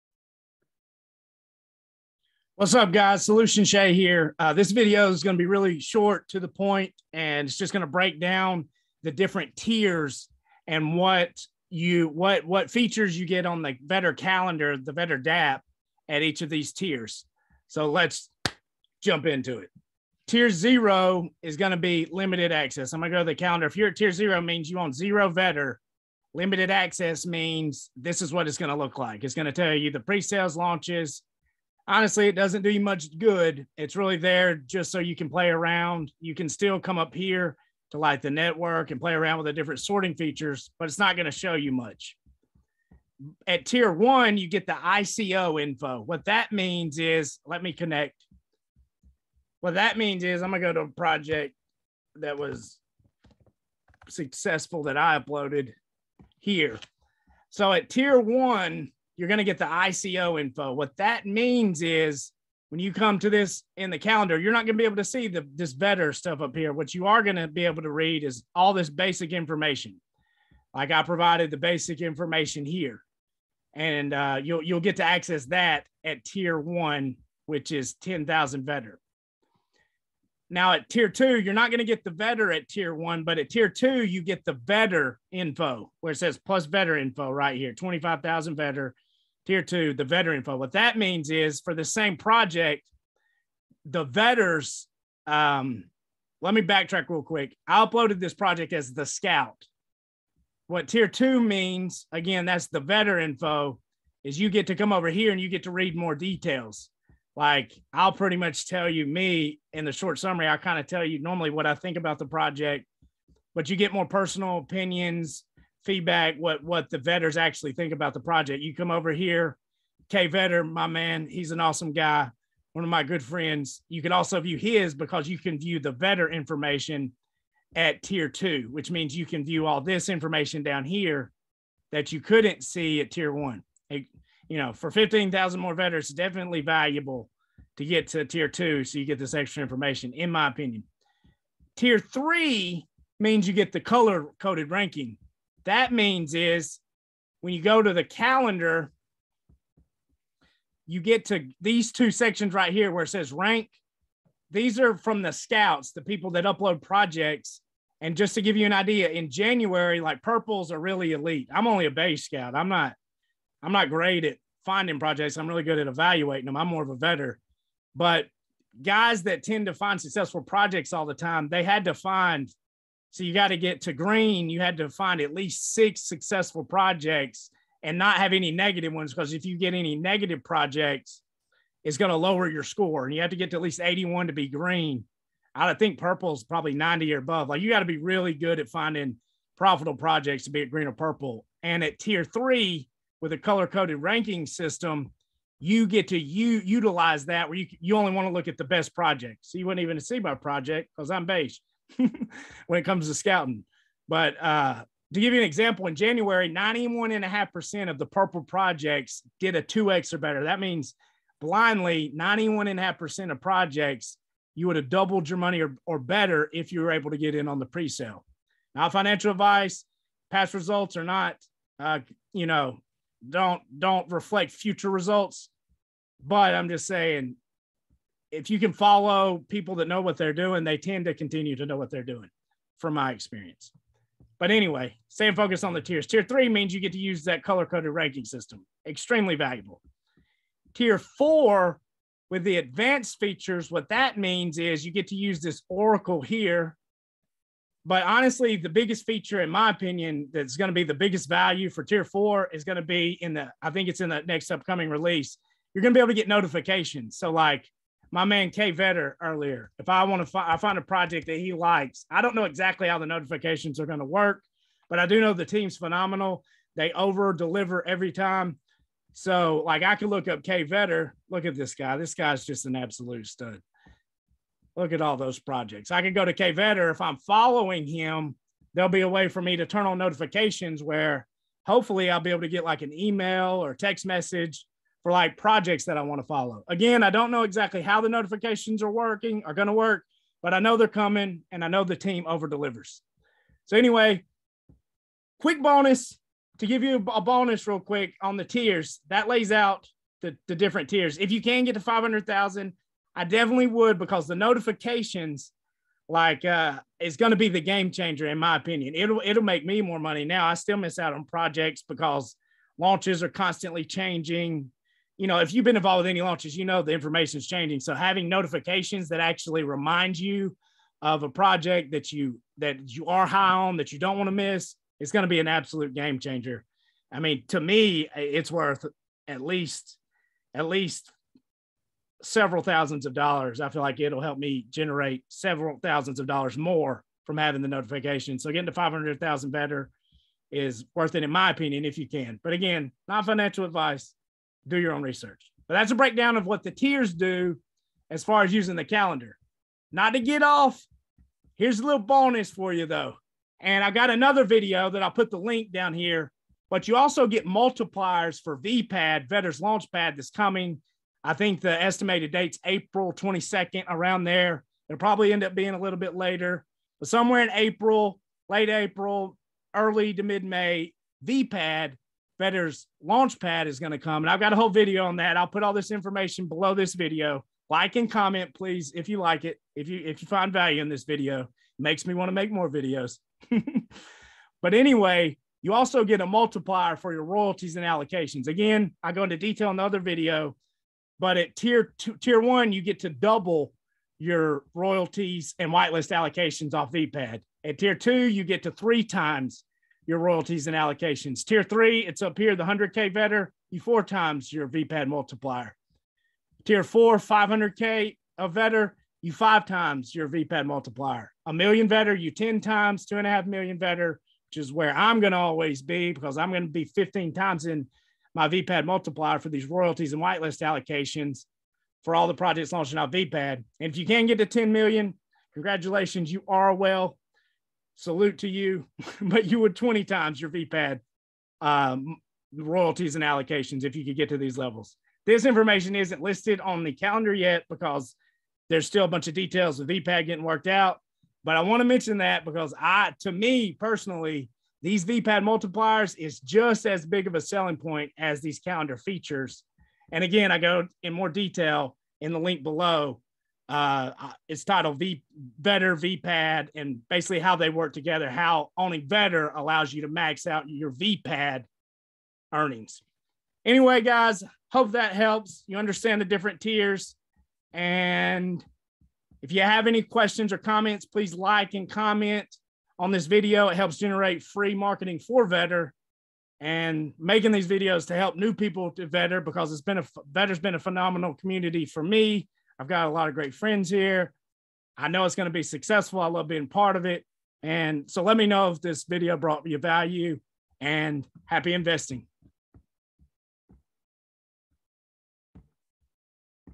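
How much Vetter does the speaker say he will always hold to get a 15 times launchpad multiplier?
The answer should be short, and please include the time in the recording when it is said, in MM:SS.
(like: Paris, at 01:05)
2.5 million, at 06:53.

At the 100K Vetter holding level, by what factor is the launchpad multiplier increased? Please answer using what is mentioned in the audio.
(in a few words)
4 times.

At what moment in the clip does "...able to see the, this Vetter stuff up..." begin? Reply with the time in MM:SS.
01:04.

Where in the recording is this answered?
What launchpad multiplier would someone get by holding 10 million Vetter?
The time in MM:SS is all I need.
07:09.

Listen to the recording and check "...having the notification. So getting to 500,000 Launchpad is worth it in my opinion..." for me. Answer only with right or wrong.
wrong.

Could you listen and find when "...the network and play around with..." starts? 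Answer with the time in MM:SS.
00:38.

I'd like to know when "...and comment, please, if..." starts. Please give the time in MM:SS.
06:17.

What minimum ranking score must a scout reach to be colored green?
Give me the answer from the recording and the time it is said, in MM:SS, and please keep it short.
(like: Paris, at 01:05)
81, at 03:03.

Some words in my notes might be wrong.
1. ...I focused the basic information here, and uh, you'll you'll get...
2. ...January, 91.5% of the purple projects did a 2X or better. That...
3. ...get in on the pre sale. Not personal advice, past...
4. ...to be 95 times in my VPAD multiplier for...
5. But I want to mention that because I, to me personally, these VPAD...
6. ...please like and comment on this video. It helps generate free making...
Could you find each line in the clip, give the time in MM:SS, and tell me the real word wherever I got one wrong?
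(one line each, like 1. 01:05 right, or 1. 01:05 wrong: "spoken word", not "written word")
1. 01:10 wrong: "provided", not "focused"
2. 03:25 right
3. 03:37 wrong: "financial", not "personal"
4. 06:56 wrong: "15", not "95"
5. 07:21 right
6. 07:51 wrong: "marketing", not "making".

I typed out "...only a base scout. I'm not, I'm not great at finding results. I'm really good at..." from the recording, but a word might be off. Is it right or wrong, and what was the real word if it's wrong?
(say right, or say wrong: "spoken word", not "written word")
wrong: "projects", not "results".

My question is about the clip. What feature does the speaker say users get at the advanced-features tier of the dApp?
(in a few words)
Oracle.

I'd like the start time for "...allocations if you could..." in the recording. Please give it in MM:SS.
07:13.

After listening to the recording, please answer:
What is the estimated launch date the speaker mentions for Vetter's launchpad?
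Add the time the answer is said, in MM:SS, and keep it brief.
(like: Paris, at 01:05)
April 22nd, at 06:02.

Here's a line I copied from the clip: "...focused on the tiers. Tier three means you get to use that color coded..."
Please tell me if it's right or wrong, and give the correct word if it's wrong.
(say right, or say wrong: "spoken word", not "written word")
right.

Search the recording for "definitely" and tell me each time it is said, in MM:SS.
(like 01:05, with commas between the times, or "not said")
02:16, 05:03.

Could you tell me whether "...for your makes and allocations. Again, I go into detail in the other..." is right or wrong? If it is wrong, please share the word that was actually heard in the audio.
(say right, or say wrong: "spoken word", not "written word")
wrong: "royalties", not "makes".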